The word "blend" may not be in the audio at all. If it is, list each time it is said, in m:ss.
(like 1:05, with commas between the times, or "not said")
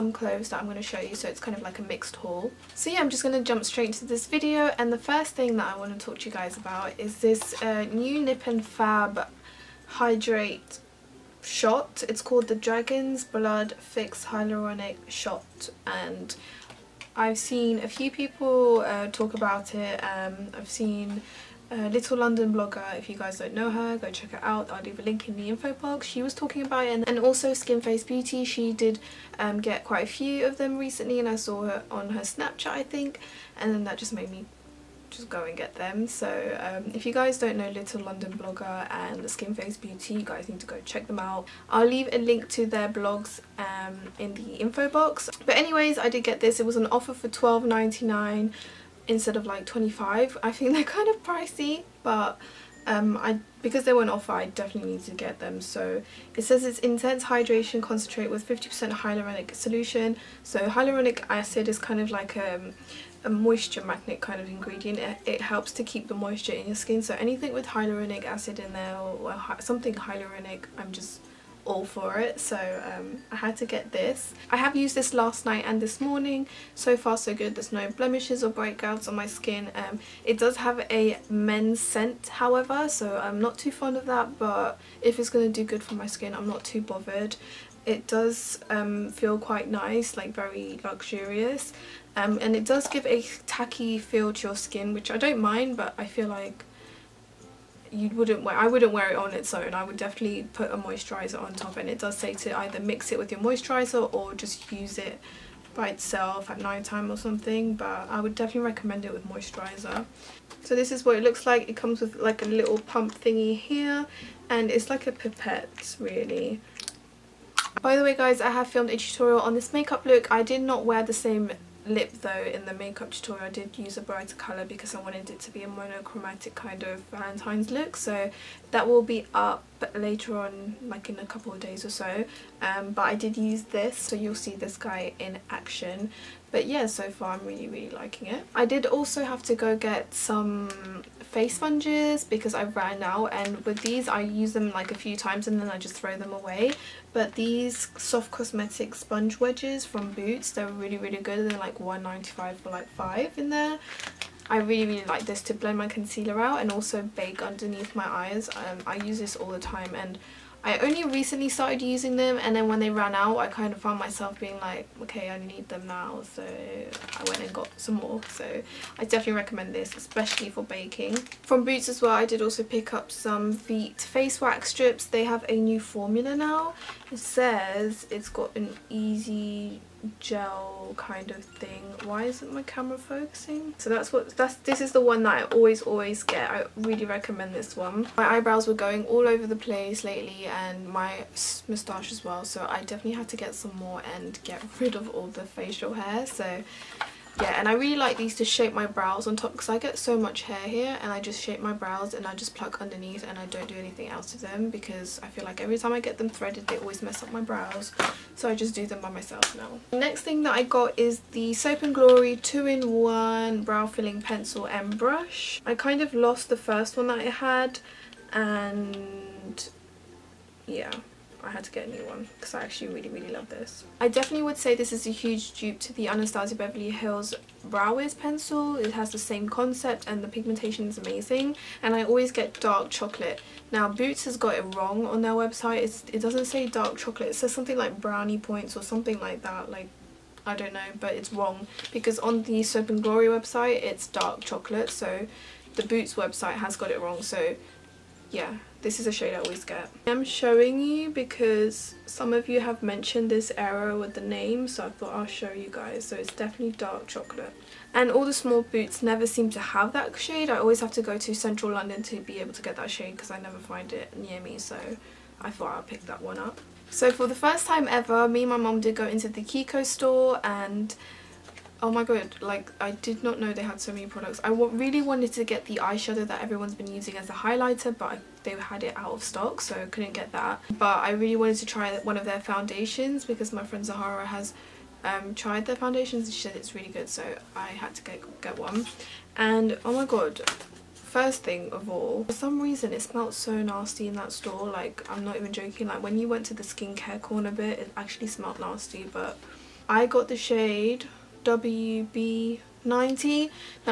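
2:35.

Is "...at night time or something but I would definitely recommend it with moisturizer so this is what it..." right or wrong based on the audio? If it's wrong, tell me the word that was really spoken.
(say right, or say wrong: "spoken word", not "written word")
right.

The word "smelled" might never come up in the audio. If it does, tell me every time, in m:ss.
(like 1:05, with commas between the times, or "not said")
4:53, 4:58.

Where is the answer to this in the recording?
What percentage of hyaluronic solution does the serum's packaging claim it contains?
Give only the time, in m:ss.
0:58.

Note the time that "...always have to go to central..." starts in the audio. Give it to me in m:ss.
4:20.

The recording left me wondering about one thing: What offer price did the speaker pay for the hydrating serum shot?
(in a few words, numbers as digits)
£12.99.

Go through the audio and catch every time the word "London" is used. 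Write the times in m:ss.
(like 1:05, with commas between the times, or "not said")
0:22, 0:38, 4:21.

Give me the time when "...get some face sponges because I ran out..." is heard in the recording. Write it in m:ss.
2:19.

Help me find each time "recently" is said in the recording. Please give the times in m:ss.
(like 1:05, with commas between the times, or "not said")
0:30, 2:41.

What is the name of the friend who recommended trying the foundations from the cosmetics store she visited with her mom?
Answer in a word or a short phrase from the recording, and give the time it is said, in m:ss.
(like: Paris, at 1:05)
Zahara, at 4:43.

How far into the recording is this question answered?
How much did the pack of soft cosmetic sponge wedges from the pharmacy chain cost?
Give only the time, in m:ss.
2:31.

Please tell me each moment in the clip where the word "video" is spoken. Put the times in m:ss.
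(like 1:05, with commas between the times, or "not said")
0:04.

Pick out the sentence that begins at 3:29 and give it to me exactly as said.
Next thing that I got is the Soap and Glory 2-in-1 brow filling pencil and brush.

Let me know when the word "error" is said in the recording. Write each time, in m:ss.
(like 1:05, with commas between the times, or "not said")
4:13.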